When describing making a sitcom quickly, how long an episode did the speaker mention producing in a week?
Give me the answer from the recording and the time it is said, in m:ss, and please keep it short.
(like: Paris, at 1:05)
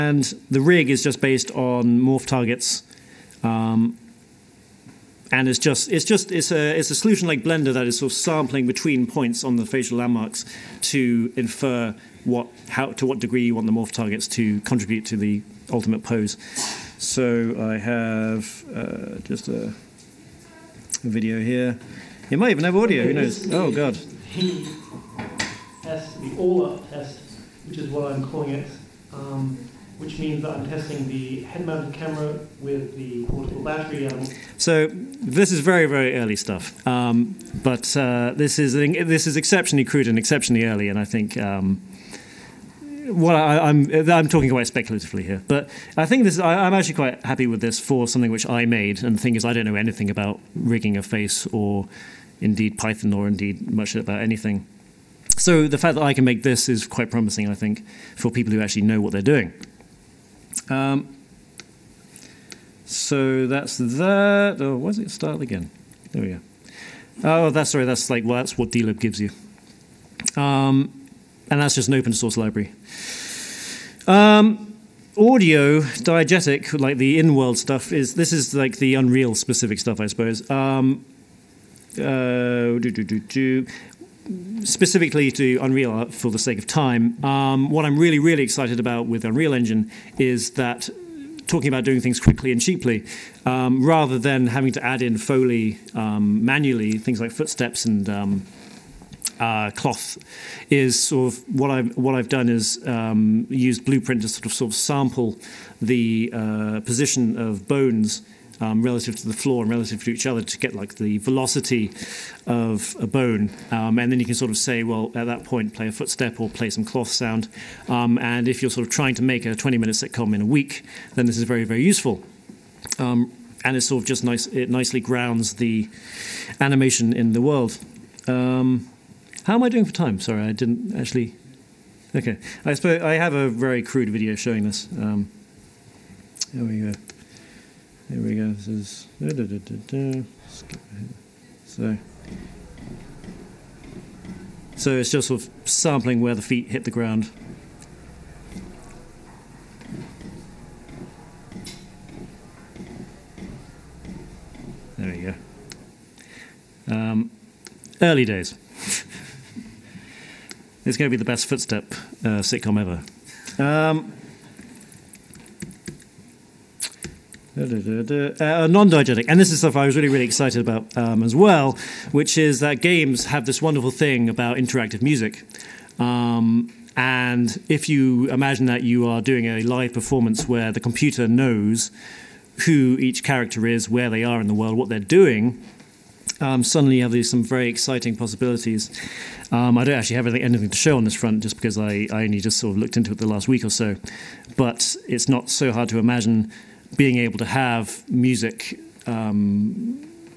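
20 minutes, at 1:59.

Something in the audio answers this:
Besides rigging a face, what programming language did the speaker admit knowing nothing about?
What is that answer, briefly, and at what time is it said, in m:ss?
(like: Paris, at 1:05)
Python, at 0:52.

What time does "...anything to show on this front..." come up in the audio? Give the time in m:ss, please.
3:10.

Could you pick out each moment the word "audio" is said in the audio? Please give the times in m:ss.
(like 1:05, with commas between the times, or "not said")
0:22, 1:15.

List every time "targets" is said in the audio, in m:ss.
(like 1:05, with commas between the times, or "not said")
0:02, 0:13.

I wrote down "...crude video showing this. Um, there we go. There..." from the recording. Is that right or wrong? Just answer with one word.
right.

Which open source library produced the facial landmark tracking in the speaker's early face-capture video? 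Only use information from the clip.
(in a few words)
DLib.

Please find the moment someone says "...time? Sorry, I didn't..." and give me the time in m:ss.
2:09.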